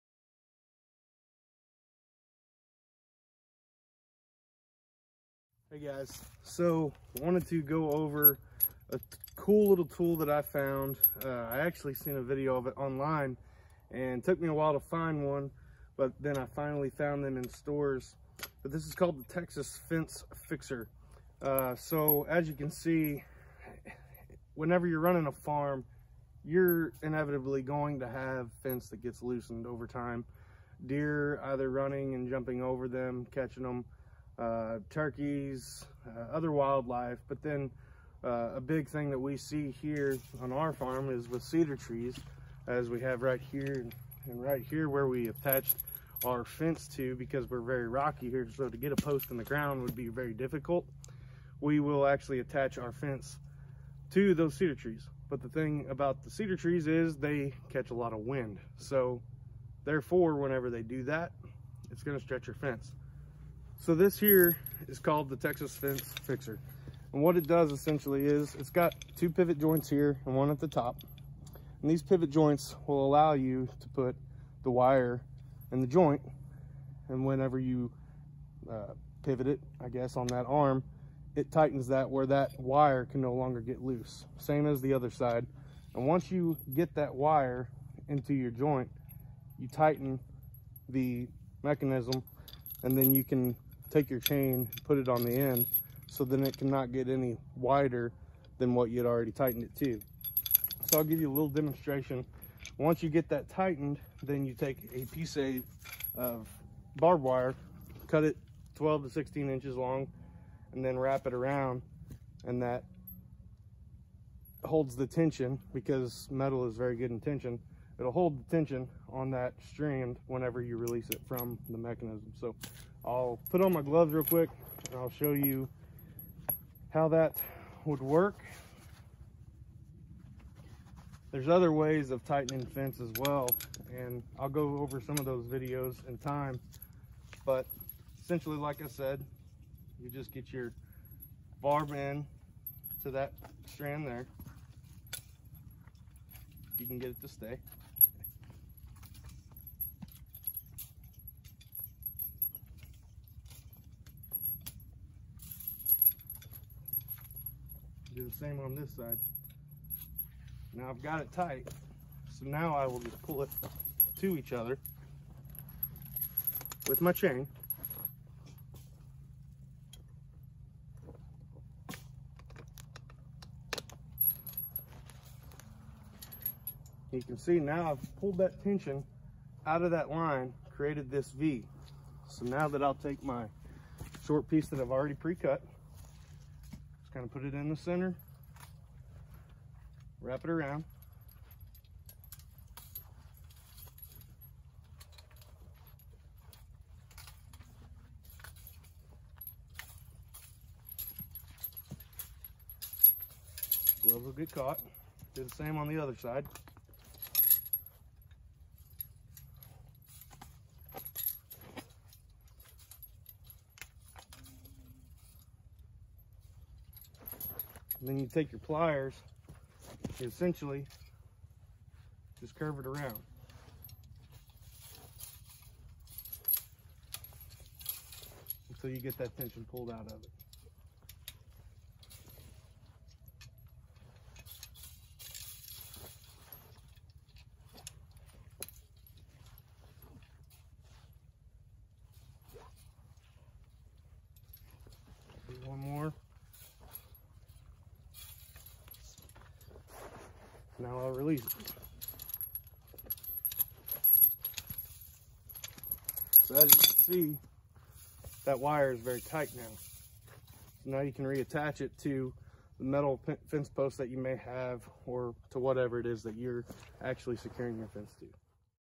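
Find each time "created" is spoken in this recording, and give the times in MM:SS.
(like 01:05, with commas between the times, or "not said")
03:00.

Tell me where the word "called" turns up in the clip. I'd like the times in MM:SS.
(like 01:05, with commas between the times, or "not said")
00:18, 01:04.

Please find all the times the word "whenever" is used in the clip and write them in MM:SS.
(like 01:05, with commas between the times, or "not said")
00:24, 01:00, 01:17, 02:00.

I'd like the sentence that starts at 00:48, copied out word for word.
So to get a post in the ground would be very difficult.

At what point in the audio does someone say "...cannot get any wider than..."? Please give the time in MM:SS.
01:36.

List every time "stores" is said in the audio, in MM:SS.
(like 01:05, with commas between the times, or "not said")
00:17.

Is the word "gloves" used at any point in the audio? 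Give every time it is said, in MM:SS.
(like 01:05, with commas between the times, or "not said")
02:03, 03:24.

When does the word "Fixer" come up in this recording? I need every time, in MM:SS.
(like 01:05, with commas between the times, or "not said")
00:20, 01:06.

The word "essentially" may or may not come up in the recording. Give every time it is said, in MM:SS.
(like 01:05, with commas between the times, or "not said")
01:07, 02:18, 03:40.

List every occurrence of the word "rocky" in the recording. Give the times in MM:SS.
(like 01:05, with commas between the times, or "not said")
00:47.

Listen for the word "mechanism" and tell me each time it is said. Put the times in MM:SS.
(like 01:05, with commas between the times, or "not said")
01:31, 02:01.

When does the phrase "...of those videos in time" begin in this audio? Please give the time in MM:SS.
02:15.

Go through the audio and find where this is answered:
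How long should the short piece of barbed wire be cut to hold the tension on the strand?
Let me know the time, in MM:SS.
01:48.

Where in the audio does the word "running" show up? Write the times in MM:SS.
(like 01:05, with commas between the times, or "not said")
00:24, 00:31.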